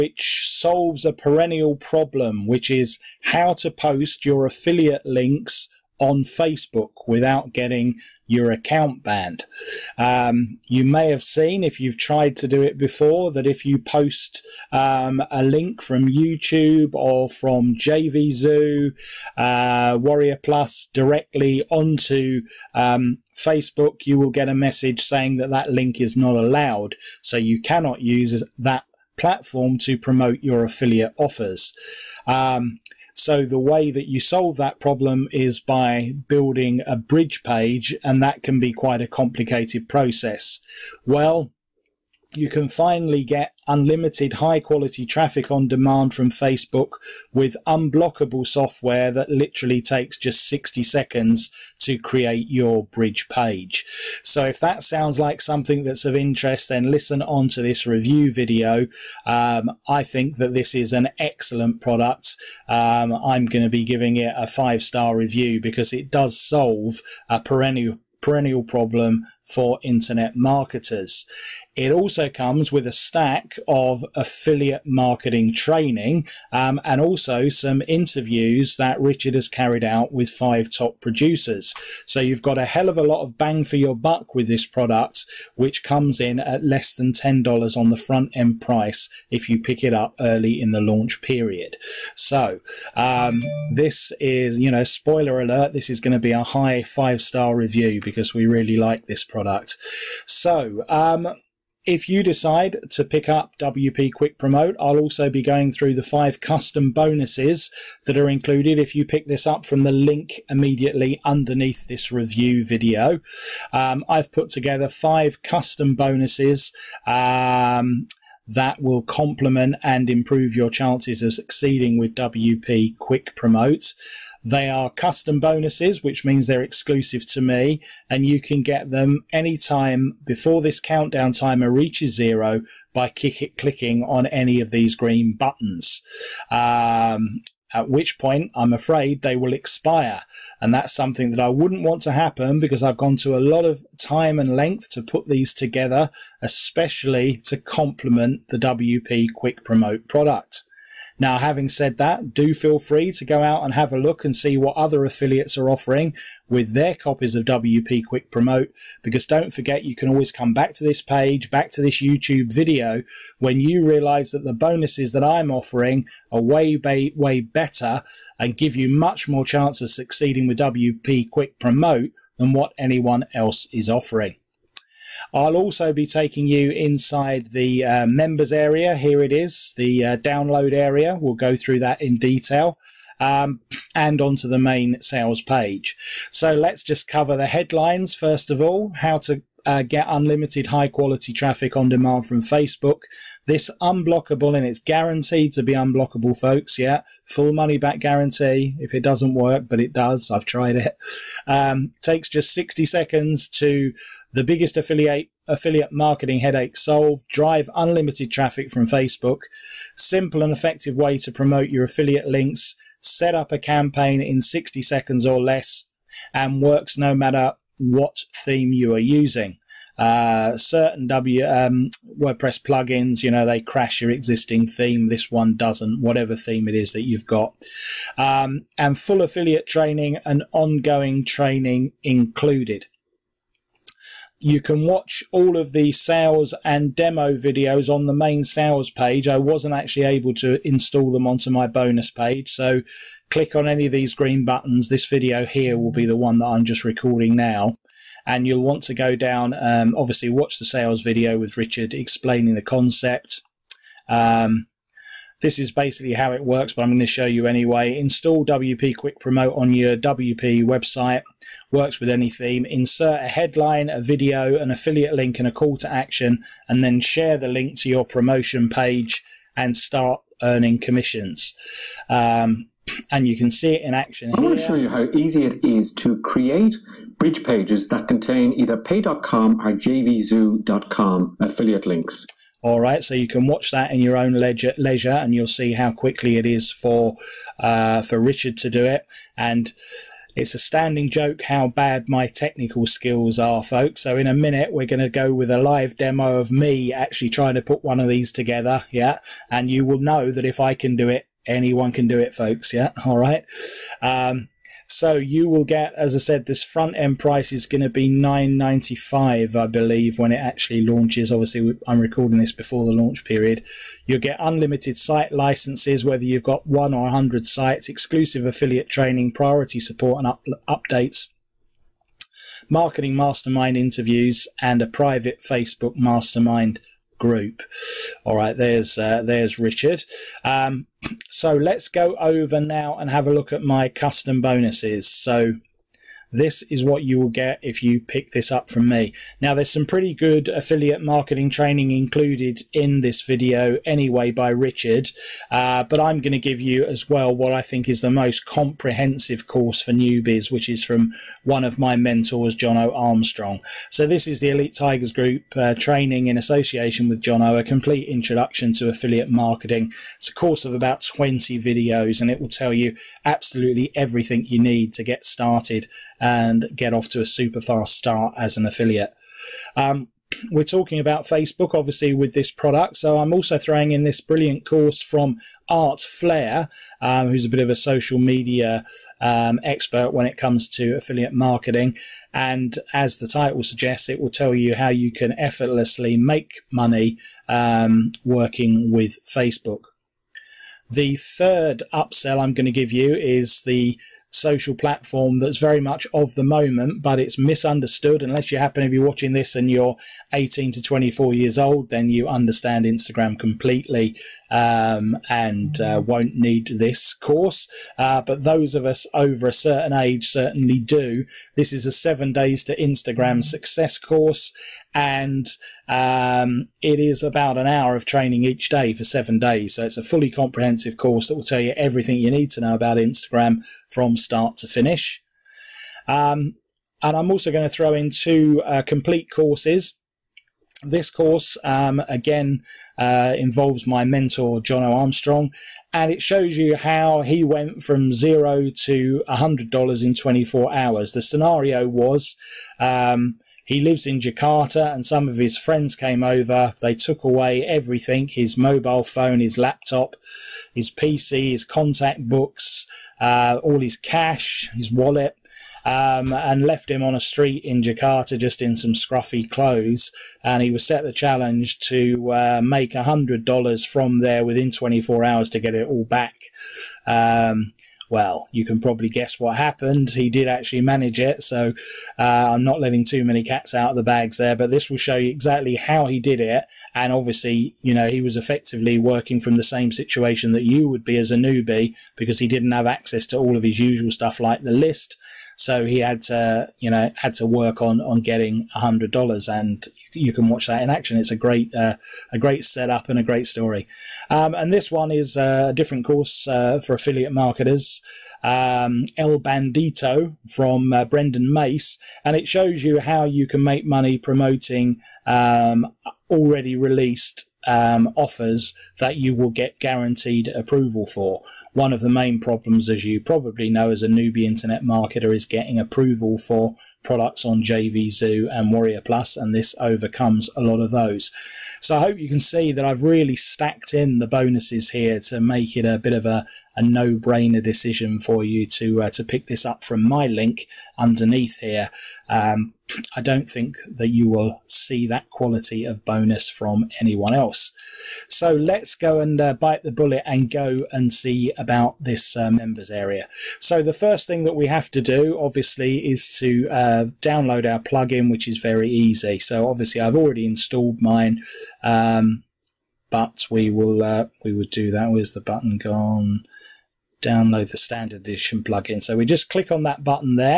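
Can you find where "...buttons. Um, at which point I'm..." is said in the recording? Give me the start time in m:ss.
2:15.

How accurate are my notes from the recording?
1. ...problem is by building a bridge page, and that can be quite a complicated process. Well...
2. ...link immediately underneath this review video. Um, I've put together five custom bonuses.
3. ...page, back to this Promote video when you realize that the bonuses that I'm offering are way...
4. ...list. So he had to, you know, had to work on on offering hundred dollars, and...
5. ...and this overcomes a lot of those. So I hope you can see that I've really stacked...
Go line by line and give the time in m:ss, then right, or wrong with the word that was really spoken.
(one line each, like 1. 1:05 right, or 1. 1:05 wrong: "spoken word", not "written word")
1. 0:34 right
2. 1:49 right
3. 2:41 wrong: "YouTube", not "Promote"
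4. 8:04 wrong: "getting", not "offering"
5. 8:39 right.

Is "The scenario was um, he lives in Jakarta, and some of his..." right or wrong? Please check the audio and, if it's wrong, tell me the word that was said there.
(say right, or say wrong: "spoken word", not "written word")
right.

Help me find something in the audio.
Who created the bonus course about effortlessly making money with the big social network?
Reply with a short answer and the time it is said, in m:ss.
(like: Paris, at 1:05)
Art Flair, at 6:15.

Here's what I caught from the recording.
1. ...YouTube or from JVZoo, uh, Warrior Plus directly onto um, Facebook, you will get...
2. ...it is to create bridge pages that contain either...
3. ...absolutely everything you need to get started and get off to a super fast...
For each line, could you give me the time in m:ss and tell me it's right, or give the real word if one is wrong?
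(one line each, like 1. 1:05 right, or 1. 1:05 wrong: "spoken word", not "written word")
1. 0:16 right
2. 4:35 right
3. 6:03 right.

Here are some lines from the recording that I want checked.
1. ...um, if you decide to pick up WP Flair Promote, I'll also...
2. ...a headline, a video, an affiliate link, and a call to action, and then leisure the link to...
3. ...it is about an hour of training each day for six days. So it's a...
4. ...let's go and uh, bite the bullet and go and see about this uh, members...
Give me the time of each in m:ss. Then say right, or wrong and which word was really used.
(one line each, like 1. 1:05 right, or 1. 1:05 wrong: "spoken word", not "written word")
1. 1:40 wrong: "Quick", not "Flair"
2. 4:23 wrong: "share", not "leisure"
3. 6:56 wrong: "seven", not "six"
4. 8:58 right.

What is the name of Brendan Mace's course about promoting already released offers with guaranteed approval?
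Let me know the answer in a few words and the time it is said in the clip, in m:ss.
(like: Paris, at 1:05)
El Bandito, at 8:19.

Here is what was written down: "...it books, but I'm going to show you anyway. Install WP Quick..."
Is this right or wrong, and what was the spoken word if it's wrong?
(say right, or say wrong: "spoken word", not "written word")
wrong: "works", not "books".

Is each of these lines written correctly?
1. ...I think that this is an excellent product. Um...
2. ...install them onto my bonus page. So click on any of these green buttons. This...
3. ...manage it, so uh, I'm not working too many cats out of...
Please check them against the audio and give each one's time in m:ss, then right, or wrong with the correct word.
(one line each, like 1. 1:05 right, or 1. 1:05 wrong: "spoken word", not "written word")
1. 0:59 right
2. 4:00 right
3. 7:50 wrong: "letting", not "working".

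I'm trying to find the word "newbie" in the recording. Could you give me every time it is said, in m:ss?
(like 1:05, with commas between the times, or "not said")
5:49, 8:01, 8:34.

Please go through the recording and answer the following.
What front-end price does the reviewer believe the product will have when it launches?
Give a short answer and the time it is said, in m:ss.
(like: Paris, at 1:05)
$9.95, at 5:08.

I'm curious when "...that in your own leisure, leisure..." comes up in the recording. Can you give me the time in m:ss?
4:43.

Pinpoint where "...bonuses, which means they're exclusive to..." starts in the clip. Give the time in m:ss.
2:05.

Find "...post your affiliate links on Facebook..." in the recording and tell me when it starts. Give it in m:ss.
0:03.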